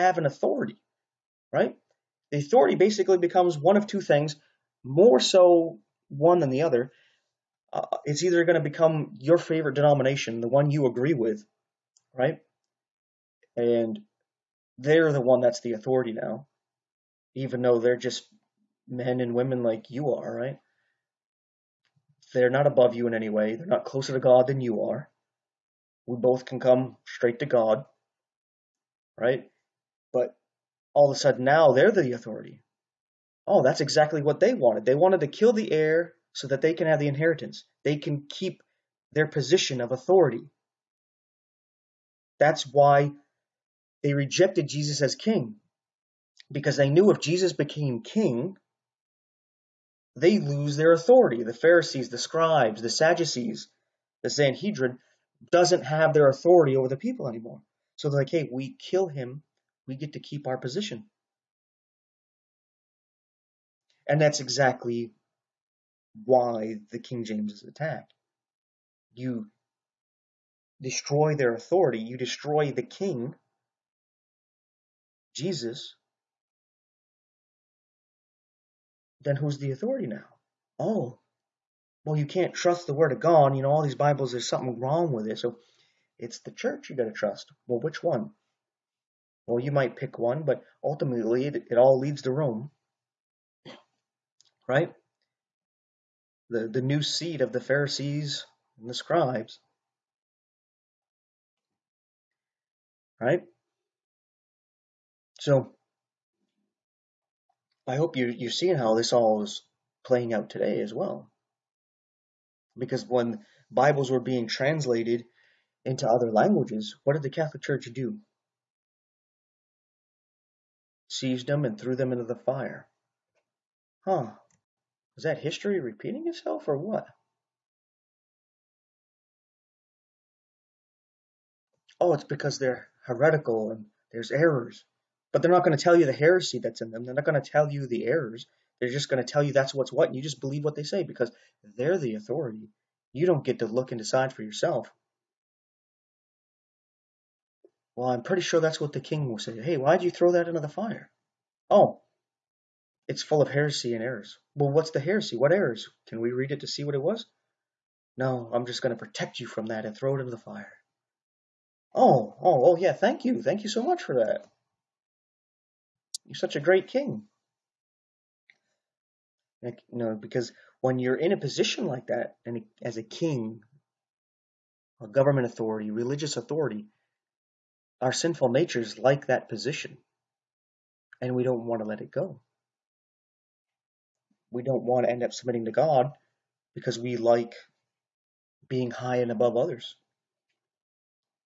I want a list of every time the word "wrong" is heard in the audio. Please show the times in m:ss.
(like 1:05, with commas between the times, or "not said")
1:24.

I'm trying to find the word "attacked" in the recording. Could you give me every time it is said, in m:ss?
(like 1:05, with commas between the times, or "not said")
1:07.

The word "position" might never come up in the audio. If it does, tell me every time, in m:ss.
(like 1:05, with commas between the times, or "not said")
0:39, 1:00, 2:51, 2:59.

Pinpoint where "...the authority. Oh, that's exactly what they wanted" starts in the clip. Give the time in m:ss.
0:31.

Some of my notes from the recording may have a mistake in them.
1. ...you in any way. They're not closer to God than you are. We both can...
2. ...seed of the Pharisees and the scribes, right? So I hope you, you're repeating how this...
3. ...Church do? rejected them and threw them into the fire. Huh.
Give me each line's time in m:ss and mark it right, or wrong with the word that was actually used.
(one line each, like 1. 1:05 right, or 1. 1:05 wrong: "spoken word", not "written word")
1. 0:22 right
2. 1:37 wrong: "seeing", not "repeating"
3. 1:57 wrong: "seized", not "rejected".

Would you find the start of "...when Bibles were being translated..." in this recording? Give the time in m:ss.
1:53.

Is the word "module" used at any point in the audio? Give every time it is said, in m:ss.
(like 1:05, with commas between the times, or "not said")
not said.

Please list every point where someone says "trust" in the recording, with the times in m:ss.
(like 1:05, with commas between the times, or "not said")
1:22, 1:27.